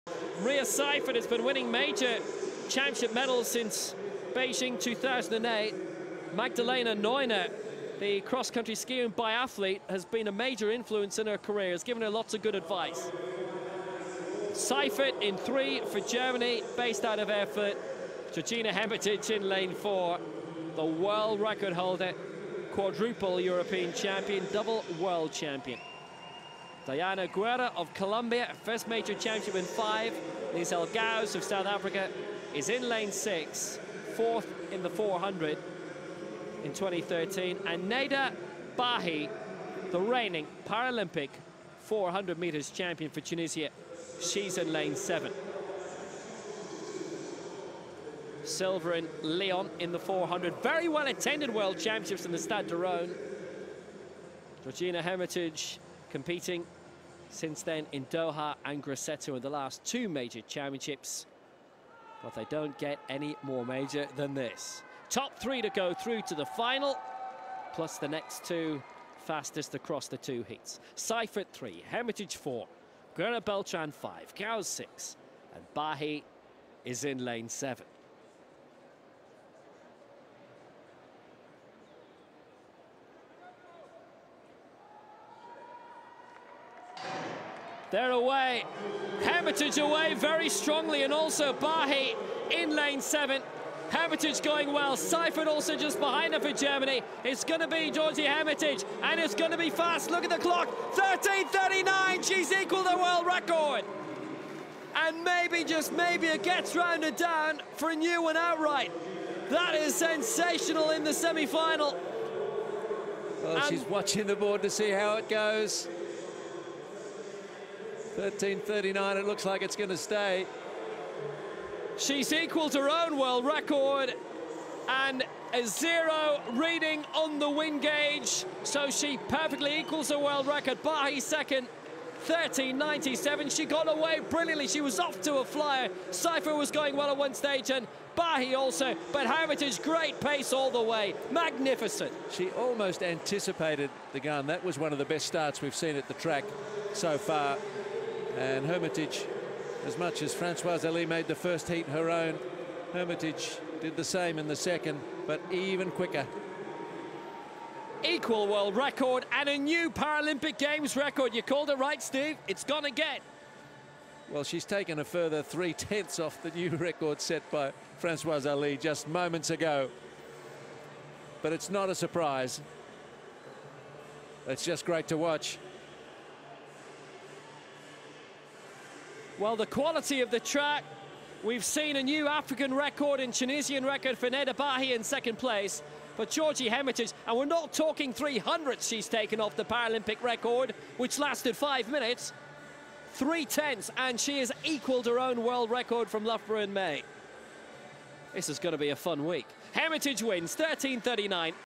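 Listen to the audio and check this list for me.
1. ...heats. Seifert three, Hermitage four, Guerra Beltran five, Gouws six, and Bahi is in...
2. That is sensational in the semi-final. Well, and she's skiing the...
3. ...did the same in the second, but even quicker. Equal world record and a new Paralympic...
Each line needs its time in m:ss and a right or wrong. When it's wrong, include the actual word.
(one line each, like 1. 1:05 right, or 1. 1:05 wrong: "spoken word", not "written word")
1. 1:10 right
2. 1:49 wrong: "watching", not "skiing"
3. 2:33 right.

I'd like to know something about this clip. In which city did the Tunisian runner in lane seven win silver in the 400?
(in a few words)
Lyon.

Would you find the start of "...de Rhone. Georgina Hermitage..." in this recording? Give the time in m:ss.
0:52.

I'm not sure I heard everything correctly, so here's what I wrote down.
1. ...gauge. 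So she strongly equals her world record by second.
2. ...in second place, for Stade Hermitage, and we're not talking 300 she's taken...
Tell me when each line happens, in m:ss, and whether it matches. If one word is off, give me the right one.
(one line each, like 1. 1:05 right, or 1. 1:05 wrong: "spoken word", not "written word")
1. 2:07 wrong: "perfectly", not "strongly"
2. 3:04 wrong: "Georgie", not "Stade".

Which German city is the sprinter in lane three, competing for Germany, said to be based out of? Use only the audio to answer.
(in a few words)
Erfurt.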